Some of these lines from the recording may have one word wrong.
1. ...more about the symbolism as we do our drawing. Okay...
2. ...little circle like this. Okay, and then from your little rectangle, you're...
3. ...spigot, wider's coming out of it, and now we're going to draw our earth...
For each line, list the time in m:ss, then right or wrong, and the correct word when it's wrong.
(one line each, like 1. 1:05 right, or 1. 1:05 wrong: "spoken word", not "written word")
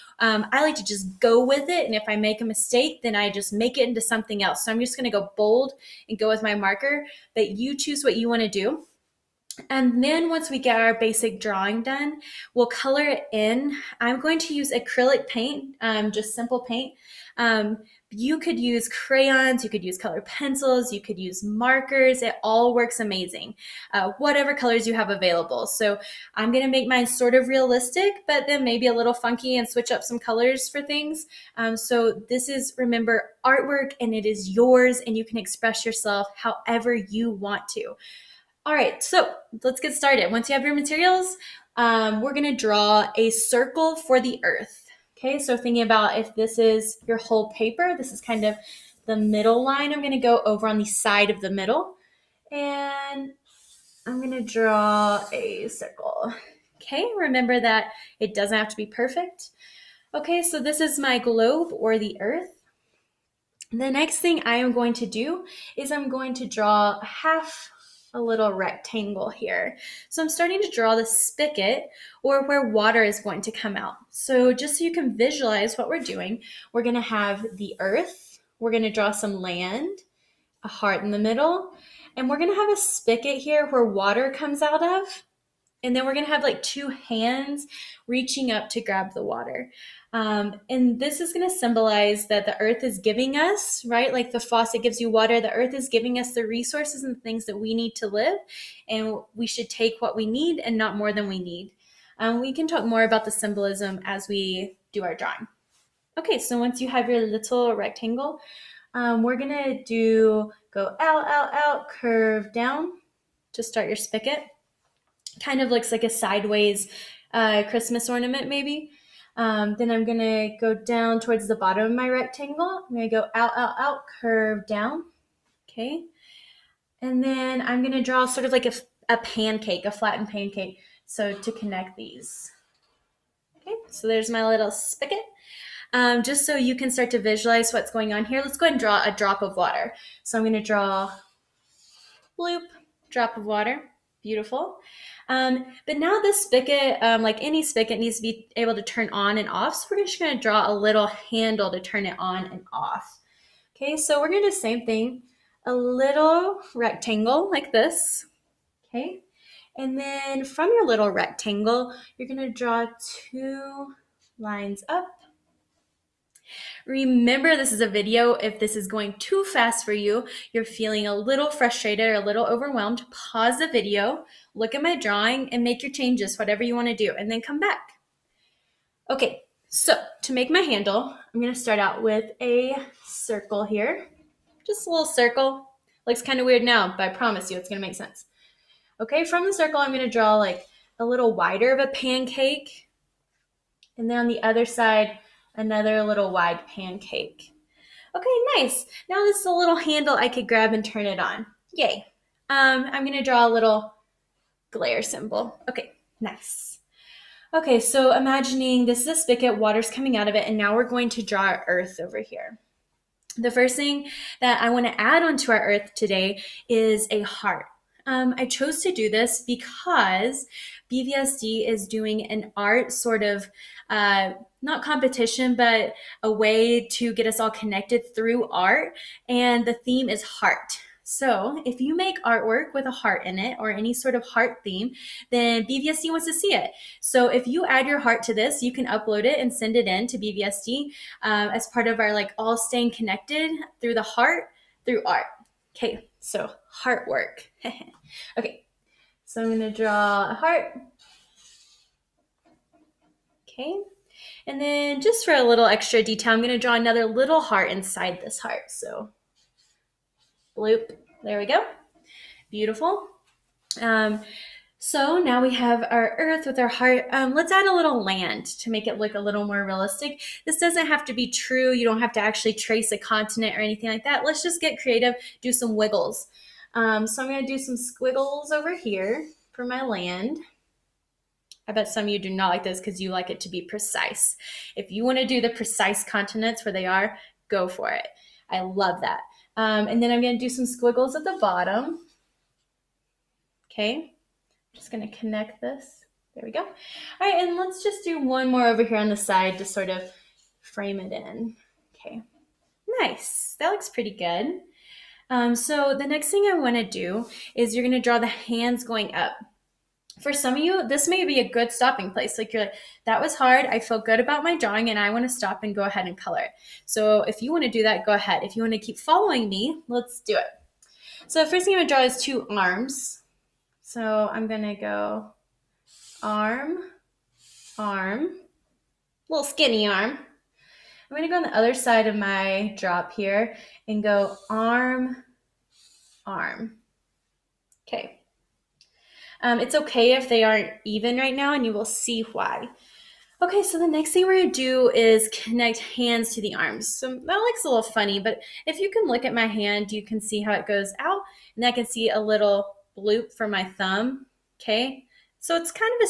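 1. 1:42 right
2. 2:35 wrong: "rectangle", not "circle"
3. 3:29 wrong: "water", not "wider".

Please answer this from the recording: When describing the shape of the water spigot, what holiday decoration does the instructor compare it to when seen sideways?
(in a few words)
Christmas ornament.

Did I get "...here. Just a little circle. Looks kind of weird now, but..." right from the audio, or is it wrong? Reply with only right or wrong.
right.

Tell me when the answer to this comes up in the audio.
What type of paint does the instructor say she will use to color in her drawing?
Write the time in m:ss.
0:14.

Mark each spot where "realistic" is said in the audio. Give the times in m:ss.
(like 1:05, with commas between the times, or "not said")
0:27, 4:29.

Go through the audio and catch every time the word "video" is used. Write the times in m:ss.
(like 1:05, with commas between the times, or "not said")
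2:47, 2:53.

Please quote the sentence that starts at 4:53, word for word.
Okay, I'm just going to connect this.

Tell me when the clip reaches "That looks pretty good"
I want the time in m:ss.
5:03.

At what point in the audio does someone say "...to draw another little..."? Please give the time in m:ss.
4:16.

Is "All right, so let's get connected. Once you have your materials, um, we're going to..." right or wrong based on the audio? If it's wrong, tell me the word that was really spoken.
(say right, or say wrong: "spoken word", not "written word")
wrong: "started", not "connected".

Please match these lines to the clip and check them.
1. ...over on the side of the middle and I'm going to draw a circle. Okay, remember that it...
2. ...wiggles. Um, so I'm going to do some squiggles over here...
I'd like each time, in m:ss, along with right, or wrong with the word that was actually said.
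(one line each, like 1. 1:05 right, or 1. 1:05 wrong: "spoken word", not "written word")
1. 0:50 right
2. 4:35 right.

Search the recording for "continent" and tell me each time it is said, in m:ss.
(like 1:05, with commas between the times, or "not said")
4:32, 4:46.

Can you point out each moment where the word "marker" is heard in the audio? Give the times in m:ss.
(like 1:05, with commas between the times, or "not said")
0:06, 0:21.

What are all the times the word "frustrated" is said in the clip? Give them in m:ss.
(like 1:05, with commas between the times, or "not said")
2:51.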